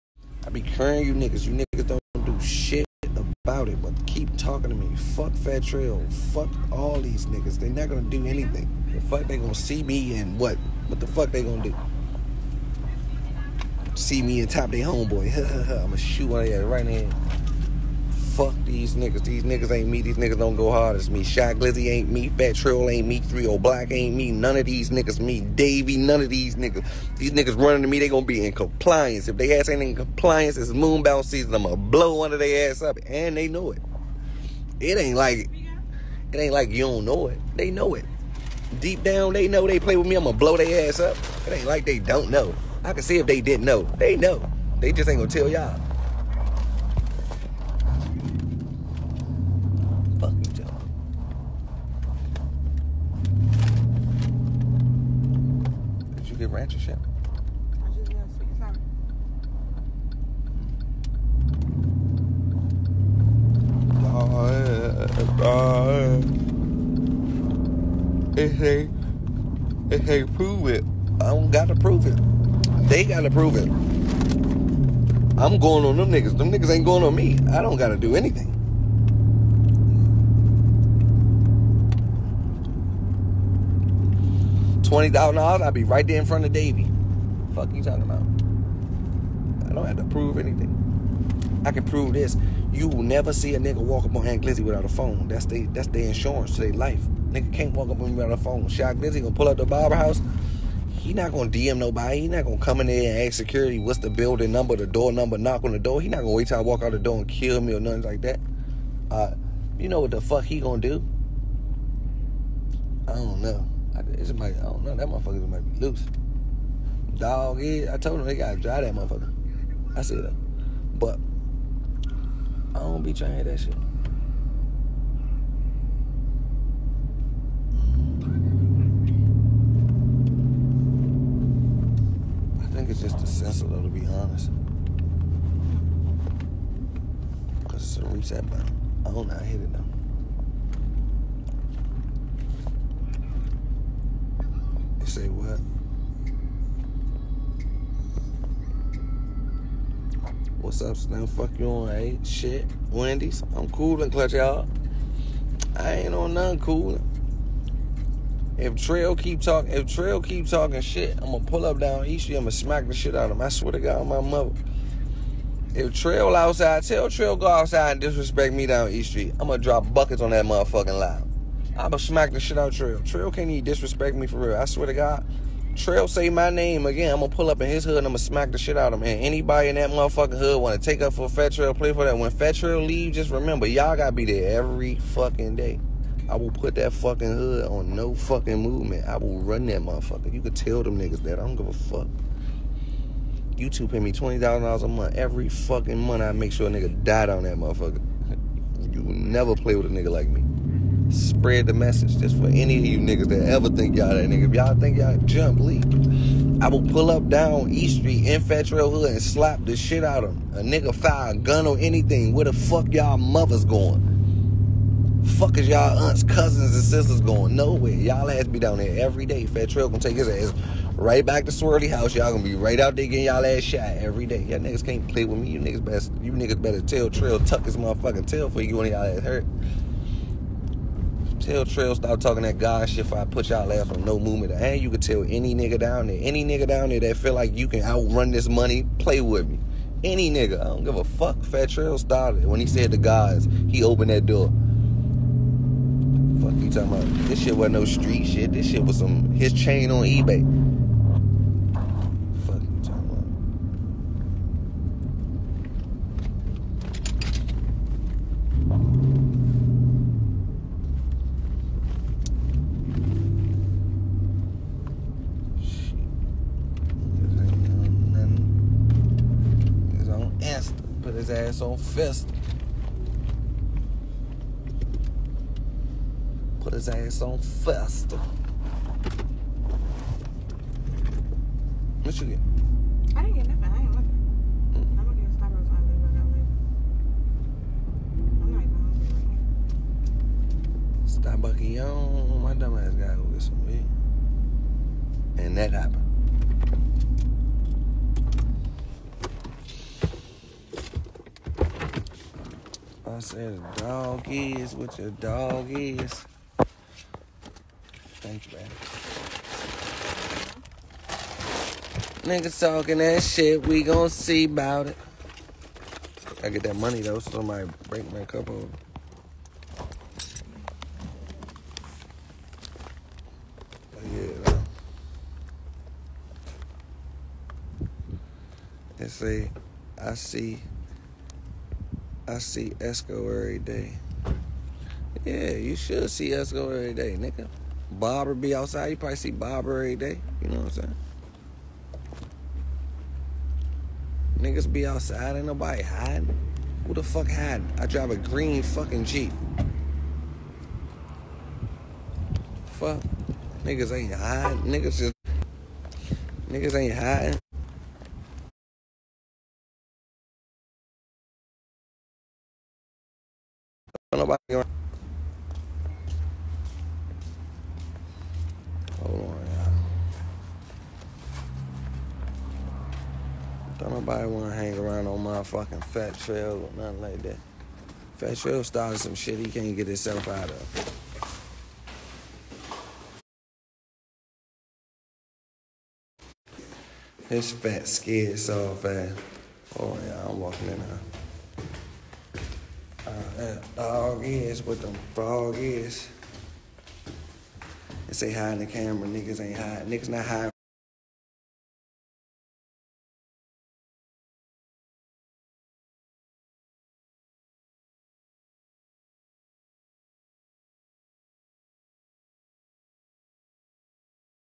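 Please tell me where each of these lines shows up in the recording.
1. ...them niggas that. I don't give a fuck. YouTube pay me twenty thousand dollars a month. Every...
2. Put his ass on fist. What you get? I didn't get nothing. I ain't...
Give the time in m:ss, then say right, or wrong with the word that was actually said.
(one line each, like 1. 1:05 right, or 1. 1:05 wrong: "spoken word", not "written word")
1. 3:10 right
2. 4:36 right.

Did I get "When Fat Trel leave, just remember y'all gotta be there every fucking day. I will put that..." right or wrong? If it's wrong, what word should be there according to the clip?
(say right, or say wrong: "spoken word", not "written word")
right.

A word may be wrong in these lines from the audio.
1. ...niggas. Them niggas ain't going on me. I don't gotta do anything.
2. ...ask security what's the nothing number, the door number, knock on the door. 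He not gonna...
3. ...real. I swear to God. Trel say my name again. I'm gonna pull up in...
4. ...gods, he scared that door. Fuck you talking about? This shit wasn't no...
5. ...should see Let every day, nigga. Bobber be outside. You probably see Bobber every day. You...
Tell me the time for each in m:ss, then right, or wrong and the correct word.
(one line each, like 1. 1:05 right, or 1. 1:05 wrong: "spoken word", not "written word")
1. 1:16 right
2. 1:43 wrong: "building", not "nothing"
3. 2:54 right
4. 4:02 wrong: "opened", not "scared"
5. 5:35 wrong: "Esco", not "Let".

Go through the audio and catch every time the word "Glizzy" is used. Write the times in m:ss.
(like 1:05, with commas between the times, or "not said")
0:21, 1:34, 1:38.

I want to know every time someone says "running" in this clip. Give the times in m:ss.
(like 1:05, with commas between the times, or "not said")
0:27.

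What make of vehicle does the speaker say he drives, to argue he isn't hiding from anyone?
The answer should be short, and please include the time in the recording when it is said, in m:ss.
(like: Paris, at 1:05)
Jeep, at 5:49.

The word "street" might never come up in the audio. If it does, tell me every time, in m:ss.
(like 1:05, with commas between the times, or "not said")
2:42, 2:49, 3:27, 4:07.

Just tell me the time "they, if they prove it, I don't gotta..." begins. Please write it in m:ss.
1:08.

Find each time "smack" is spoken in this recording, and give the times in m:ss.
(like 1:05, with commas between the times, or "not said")
2:42, 2:51, 2:58.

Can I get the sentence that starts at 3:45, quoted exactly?
You niggas best you niggas better tell Trel tuck his motherfucking tail for you when y'all ass hurt.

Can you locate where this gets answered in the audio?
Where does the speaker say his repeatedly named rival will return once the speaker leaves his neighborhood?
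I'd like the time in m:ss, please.
3:41.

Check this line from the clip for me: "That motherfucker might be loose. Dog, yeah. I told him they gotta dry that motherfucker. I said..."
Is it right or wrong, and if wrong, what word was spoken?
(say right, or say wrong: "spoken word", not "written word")
right.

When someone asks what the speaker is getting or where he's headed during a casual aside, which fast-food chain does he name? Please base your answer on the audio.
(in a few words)
Wendy's.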